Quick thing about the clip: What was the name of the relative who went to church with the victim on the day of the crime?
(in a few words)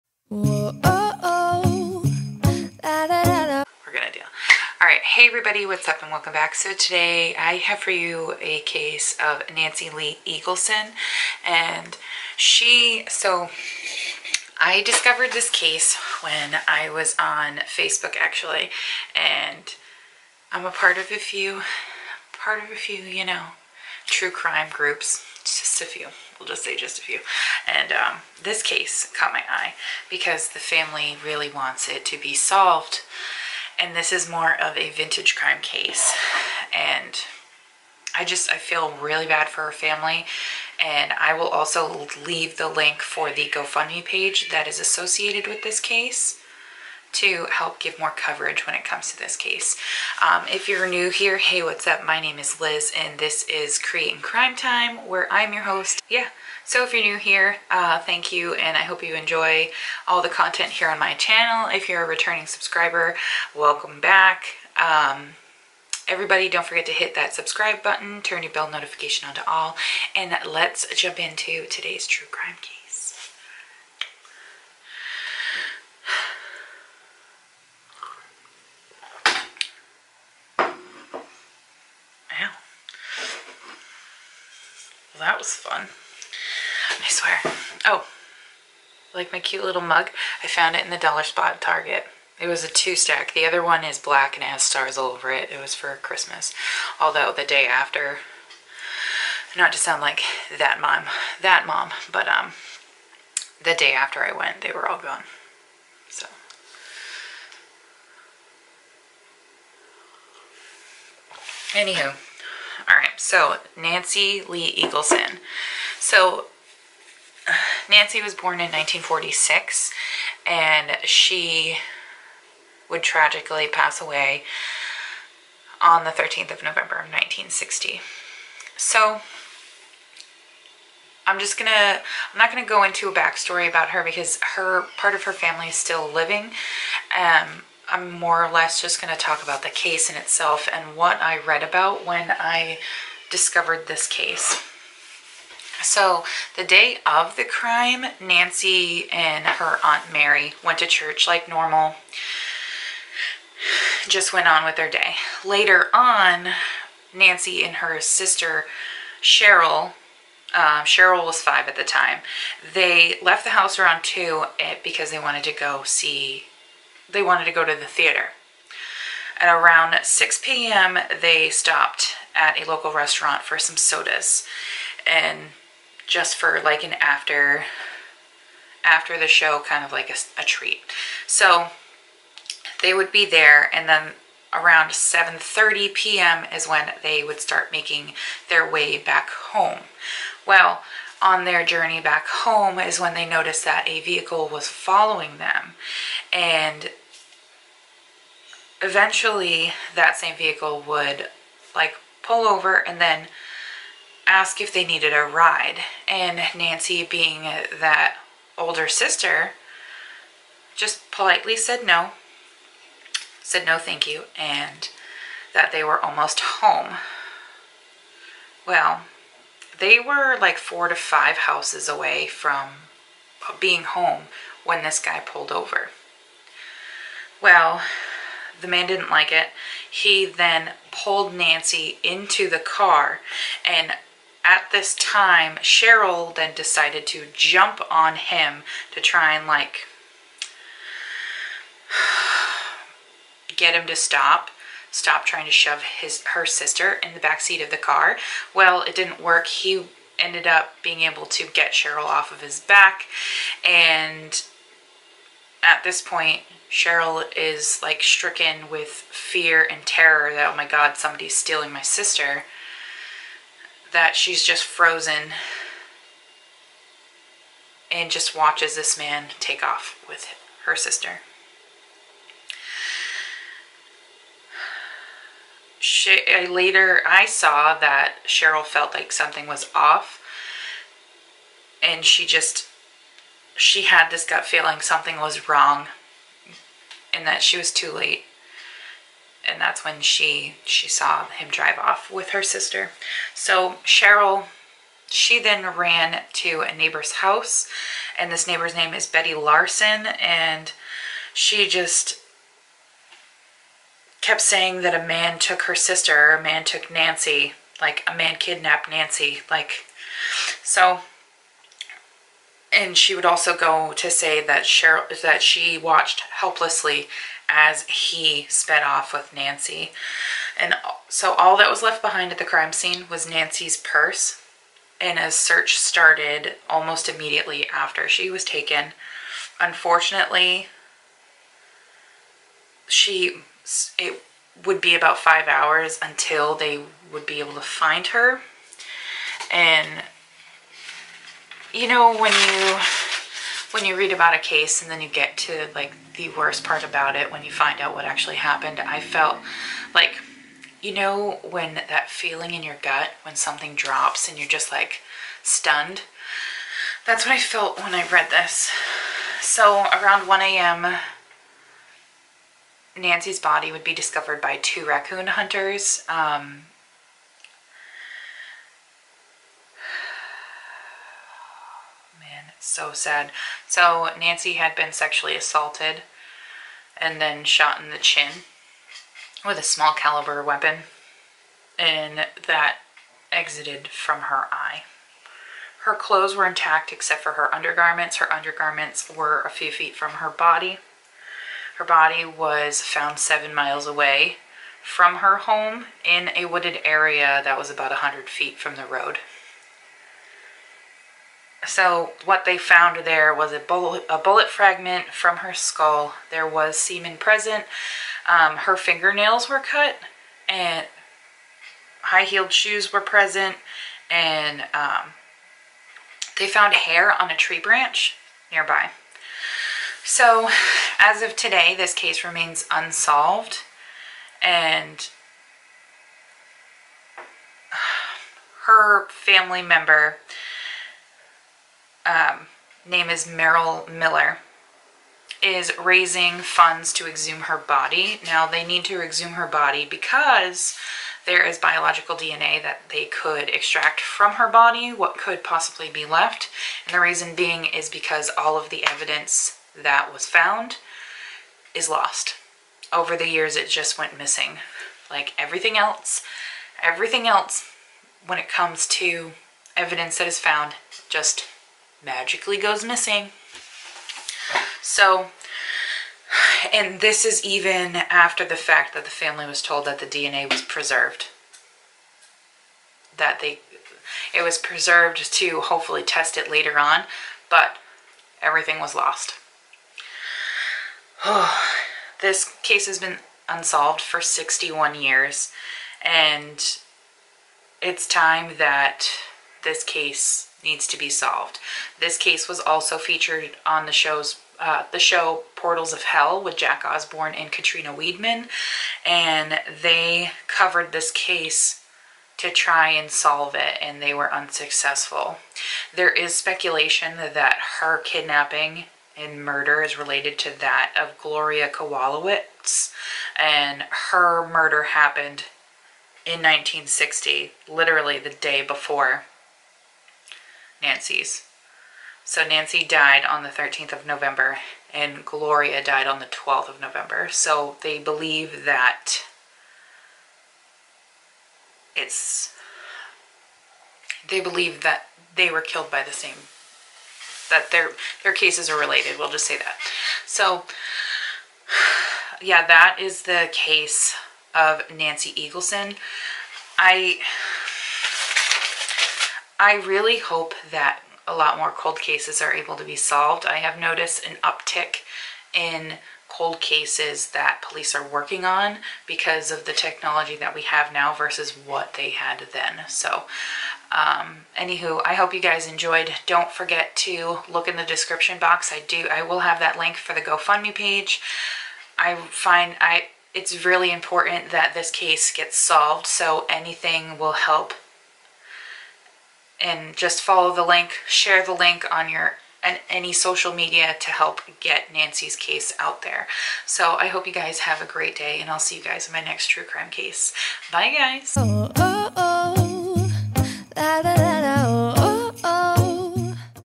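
Aunt Mary.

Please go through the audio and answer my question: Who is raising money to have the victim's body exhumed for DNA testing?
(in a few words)
Merrill Miller.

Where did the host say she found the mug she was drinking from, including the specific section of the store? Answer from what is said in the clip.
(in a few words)
Dollar spot at Target.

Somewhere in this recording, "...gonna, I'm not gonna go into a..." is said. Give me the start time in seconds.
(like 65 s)
131 s.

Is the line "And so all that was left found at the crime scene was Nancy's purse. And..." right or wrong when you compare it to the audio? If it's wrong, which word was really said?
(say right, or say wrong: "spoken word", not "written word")
wrong: "behind", not "found".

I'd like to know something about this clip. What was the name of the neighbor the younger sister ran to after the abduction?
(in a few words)
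Betty Larson.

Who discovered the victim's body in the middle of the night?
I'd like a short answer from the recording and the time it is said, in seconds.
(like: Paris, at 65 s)
Two raccoon hunters, at 364 s.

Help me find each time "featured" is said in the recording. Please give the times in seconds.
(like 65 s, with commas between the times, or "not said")
492 s.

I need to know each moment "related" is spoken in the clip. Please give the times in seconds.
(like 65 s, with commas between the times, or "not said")
509 s, 538 s.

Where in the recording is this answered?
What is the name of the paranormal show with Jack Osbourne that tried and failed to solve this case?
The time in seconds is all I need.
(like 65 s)
495 s.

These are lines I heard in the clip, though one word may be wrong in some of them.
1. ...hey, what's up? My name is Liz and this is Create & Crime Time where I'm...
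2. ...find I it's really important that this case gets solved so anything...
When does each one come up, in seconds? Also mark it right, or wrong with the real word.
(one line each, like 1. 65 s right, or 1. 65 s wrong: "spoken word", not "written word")
1. 51 s right
2. 572 s right.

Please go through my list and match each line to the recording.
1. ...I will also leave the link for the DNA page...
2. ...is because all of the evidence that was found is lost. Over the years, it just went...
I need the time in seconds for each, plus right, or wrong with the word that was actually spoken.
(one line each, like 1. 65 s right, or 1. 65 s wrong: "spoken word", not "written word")
1. 41 s wrong: "GoFundMe", not "DNA"
2. 447 s right.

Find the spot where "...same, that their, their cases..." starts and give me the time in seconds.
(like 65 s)
536 s.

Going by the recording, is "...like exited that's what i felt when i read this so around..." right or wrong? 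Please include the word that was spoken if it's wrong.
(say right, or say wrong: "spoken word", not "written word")
wrong: "stunned", not "exited".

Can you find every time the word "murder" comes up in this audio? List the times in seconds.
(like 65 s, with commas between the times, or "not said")
509 s, 514 s.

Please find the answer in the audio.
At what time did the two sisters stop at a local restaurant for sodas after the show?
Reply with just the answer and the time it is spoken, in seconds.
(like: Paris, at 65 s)
6 p.m., at 170 s.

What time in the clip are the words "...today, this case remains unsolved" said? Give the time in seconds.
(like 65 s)
421 s.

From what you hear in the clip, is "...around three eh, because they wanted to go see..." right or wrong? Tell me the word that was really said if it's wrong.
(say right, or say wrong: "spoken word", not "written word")
wrong: "two", not "three".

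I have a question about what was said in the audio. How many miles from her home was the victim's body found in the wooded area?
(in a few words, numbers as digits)
7 miles.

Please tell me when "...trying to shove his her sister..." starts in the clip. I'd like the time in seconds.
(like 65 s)
245 s.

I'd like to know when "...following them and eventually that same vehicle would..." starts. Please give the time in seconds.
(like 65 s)
194 s.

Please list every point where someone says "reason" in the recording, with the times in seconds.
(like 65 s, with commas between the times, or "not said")
446 s.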